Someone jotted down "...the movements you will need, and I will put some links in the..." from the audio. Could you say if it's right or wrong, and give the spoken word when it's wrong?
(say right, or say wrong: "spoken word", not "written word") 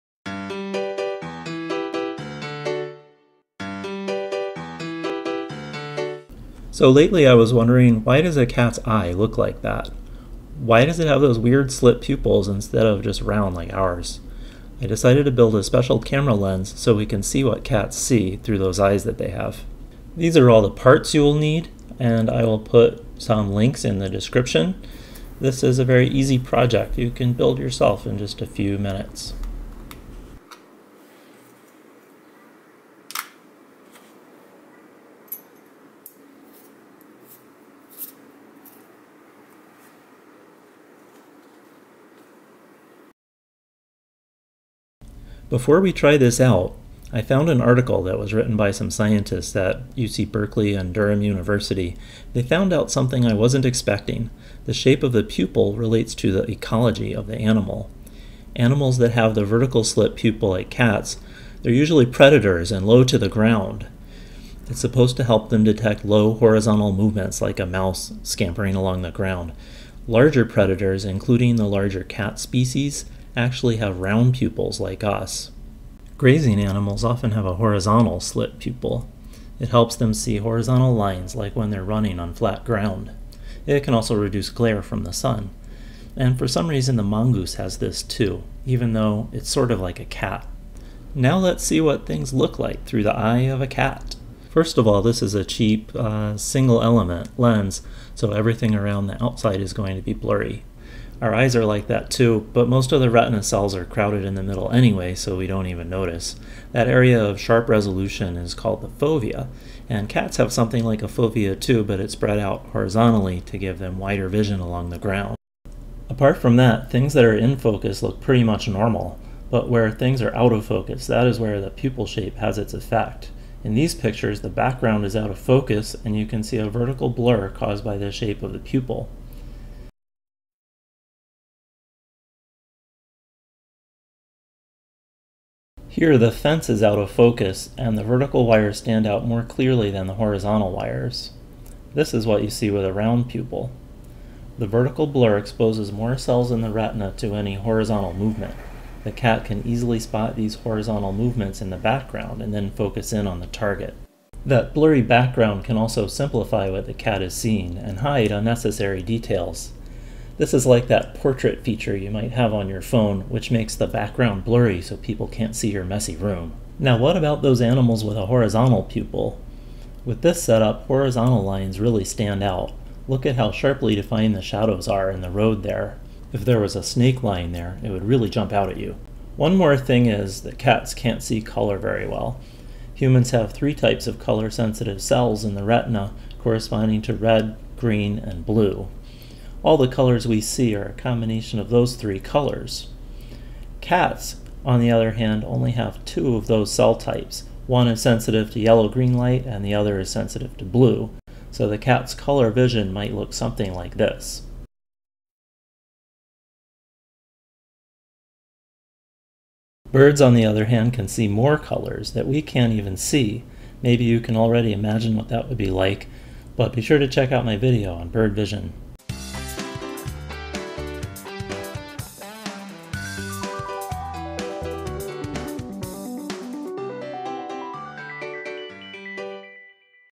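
wrong: "parts", not "movements".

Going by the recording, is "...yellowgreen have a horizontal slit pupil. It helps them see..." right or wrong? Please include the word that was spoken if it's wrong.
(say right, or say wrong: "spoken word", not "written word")
wrong: "often", not "yellowgreen".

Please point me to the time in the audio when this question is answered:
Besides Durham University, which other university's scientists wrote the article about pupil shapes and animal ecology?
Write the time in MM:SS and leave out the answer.
00:49.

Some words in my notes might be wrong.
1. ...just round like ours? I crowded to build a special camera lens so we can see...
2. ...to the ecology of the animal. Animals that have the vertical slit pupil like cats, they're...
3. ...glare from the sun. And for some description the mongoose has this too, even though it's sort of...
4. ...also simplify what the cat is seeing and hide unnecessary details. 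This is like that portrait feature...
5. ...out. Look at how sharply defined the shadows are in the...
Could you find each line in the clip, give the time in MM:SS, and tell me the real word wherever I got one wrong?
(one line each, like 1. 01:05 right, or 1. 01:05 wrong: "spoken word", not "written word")
1. 00:13 wrong: "decided", not "crowded"
2. 00:56 right
3. 01:24 wrong: "reason", not "description"
4. 02:35 right
5. 02:52 right.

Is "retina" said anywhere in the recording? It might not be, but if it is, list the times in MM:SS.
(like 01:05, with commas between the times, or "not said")
01:43, 02:26, 03:05.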